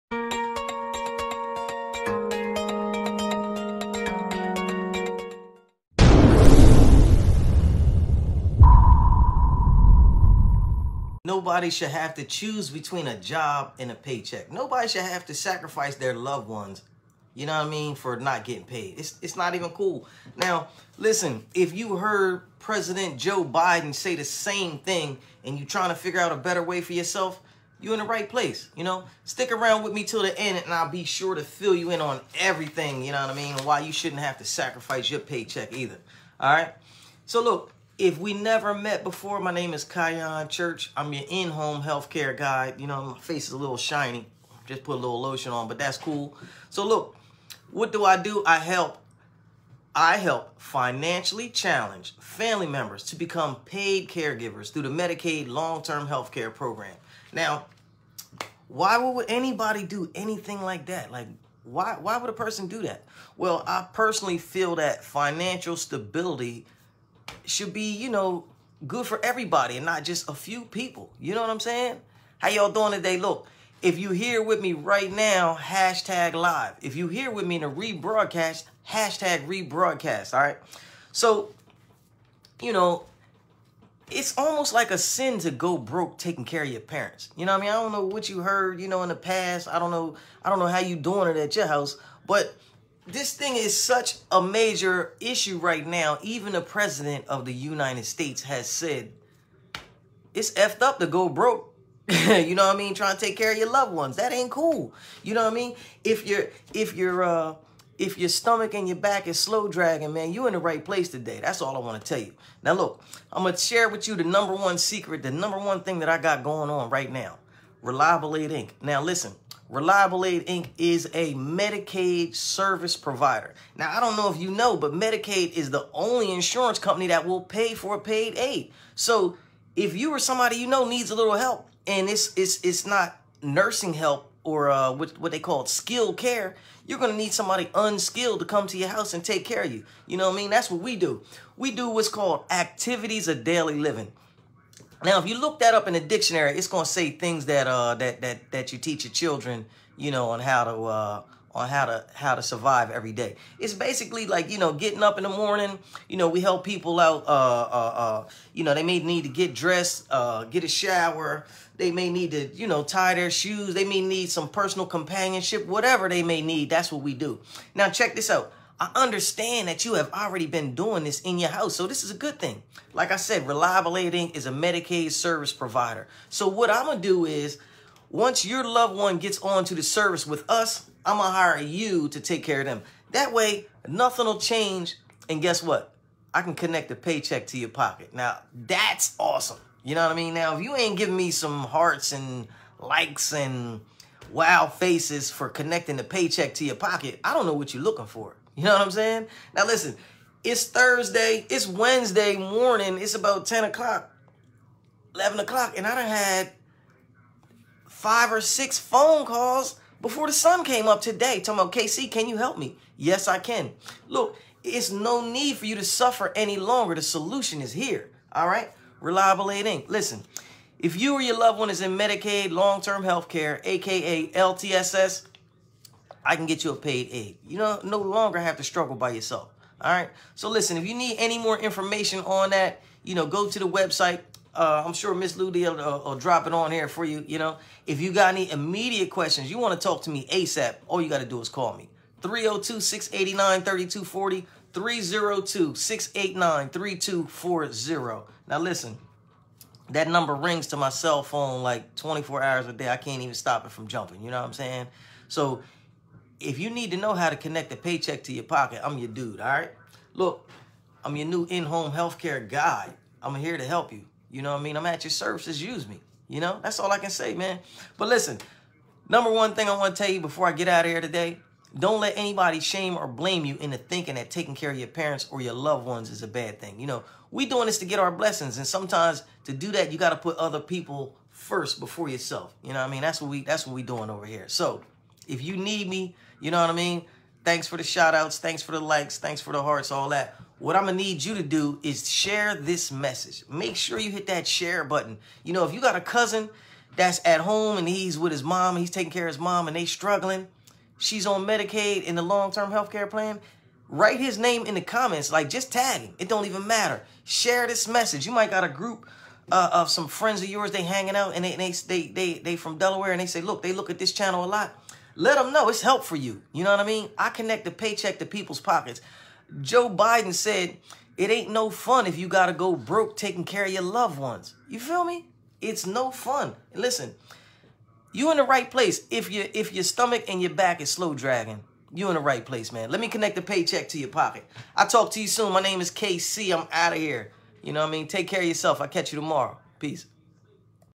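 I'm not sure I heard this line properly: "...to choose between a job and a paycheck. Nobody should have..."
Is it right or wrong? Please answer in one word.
right.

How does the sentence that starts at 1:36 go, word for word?
Even the president of the United States has said it's effed up to go broke.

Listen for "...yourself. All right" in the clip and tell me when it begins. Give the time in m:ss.
3:49.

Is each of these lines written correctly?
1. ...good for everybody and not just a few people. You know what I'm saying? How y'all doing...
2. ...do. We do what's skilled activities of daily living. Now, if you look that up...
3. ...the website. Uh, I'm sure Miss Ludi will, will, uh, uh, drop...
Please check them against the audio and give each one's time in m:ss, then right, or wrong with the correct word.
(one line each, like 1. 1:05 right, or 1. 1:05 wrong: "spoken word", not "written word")
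1. 1:08 right
2. 2:20 wrong: "called", not "skilled"
3. 3:53 right.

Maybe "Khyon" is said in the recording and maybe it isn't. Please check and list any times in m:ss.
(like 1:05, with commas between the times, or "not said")
0:39.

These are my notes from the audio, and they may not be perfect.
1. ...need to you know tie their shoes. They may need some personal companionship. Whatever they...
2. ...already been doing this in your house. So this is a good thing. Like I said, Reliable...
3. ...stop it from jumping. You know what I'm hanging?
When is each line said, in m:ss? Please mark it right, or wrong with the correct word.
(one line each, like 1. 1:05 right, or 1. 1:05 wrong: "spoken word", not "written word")
1. 2:42 right
2. 2:50 right
3. 4:13 wrong: "saying", not "hanging".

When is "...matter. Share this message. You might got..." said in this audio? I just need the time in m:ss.
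5:06.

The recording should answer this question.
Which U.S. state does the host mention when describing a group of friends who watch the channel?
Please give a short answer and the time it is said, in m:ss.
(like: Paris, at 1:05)
Delaware, at 5:12.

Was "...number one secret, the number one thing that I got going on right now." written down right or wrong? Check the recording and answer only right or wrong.
right.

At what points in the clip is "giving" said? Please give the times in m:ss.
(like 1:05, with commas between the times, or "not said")
3:10.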